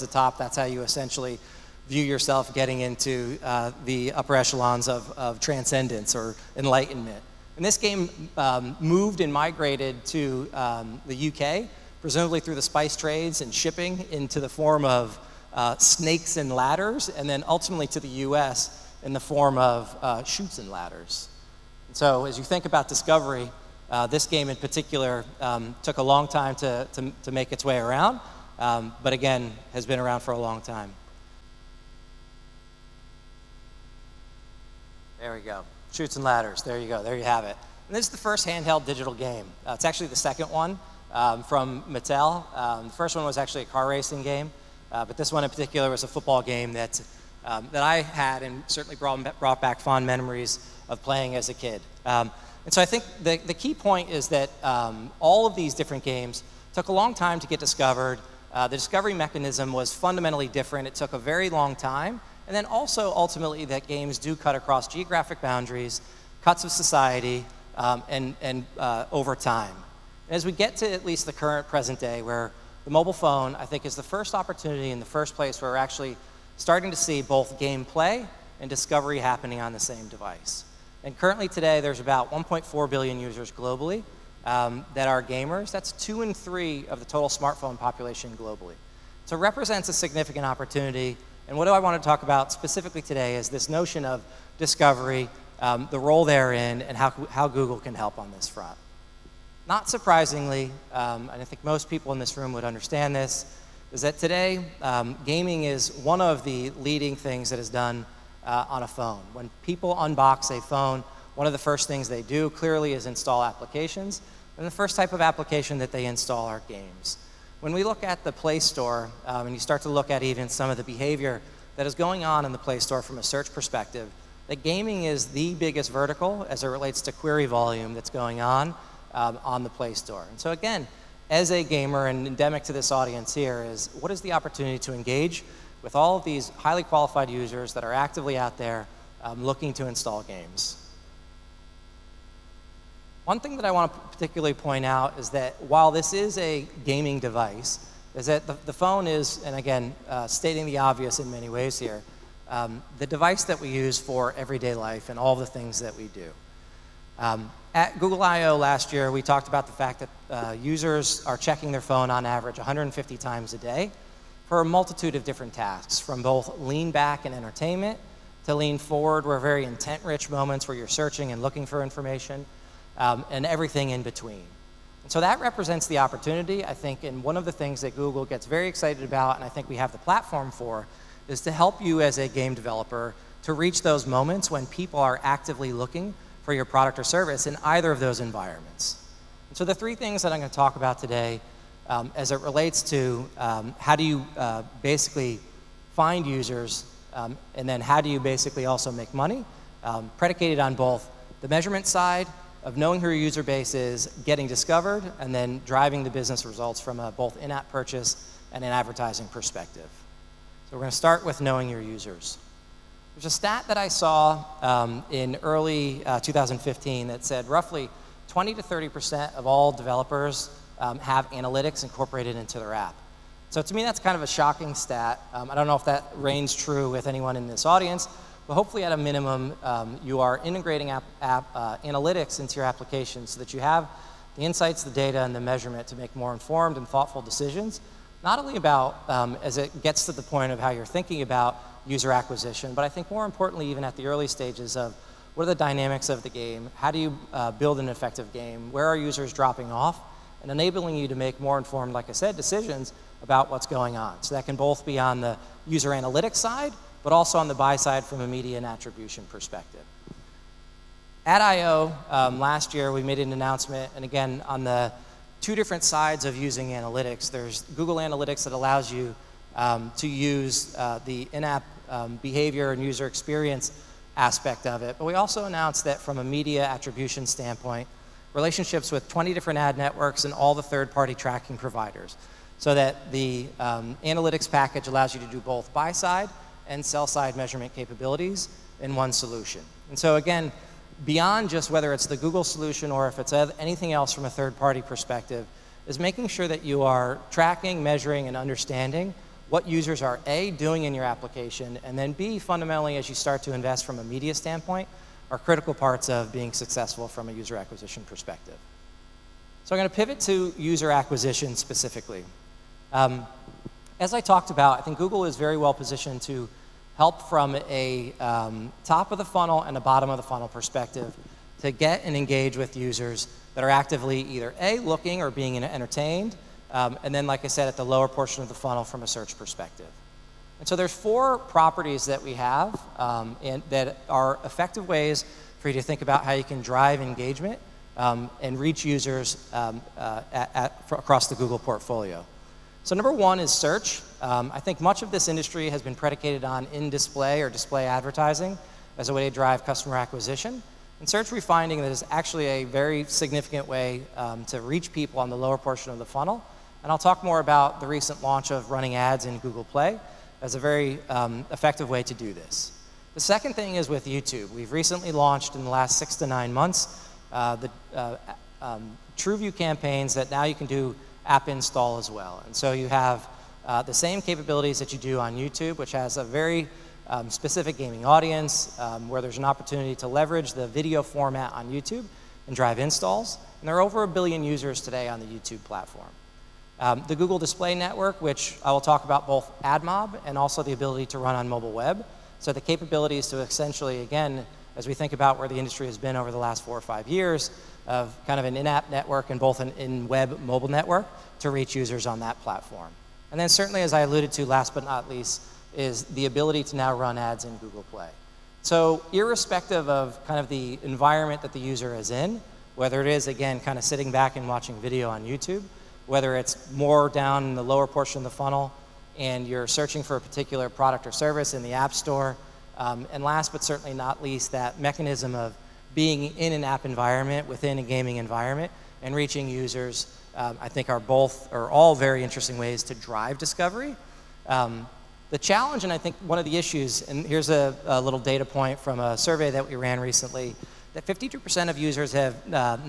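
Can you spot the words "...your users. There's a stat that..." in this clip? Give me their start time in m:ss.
3:31.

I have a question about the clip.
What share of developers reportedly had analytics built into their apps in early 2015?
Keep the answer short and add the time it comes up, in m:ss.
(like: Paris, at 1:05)
20 to 30%, at 3:38.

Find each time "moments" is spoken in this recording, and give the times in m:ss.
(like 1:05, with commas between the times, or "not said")
2:50, 3:04.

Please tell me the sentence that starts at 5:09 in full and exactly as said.
So I'm going to pivot to user acquisition specifically.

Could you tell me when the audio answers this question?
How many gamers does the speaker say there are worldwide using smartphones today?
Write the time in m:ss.
1:22.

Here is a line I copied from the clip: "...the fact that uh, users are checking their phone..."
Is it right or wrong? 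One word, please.
right.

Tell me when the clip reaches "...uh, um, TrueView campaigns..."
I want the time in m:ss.
6:07.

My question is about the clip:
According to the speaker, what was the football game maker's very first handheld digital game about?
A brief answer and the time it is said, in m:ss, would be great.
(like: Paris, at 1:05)
car racing, at 0:43.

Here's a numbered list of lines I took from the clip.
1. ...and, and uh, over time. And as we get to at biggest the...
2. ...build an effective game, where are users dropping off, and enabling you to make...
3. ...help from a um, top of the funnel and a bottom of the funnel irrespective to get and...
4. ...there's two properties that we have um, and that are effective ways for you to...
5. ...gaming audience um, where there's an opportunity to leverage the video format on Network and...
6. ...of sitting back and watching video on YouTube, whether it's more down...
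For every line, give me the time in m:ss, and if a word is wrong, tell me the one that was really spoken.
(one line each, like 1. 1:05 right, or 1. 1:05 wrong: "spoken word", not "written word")
1. 1:08 wrong: "least", not "biggest"
2. 4:07 right
3. 5:16 wrong: "perspective", not "irrespective"
4. 5:30 wrong: "four", not "two"
5. 6:17 wrong: "YouTube", not "Network"
6. 6:53 right.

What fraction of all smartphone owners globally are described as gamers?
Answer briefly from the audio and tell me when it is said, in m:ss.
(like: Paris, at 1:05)
two in three, at 1:25.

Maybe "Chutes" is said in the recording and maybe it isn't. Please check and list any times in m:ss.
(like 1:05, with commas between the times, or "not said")
0:20, 0:35.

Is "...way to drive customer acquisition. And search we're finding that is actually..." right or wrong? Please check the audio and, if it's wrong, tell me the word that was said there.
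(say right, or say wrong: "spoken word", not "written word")
right.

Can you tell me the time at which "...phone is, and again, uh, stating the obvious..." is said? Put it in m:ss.
2:28.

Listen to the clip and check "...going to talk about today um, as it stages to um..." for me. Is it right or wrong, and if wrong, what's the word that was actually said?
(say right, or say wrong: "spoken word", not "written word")
wrong: "relates", not "stages".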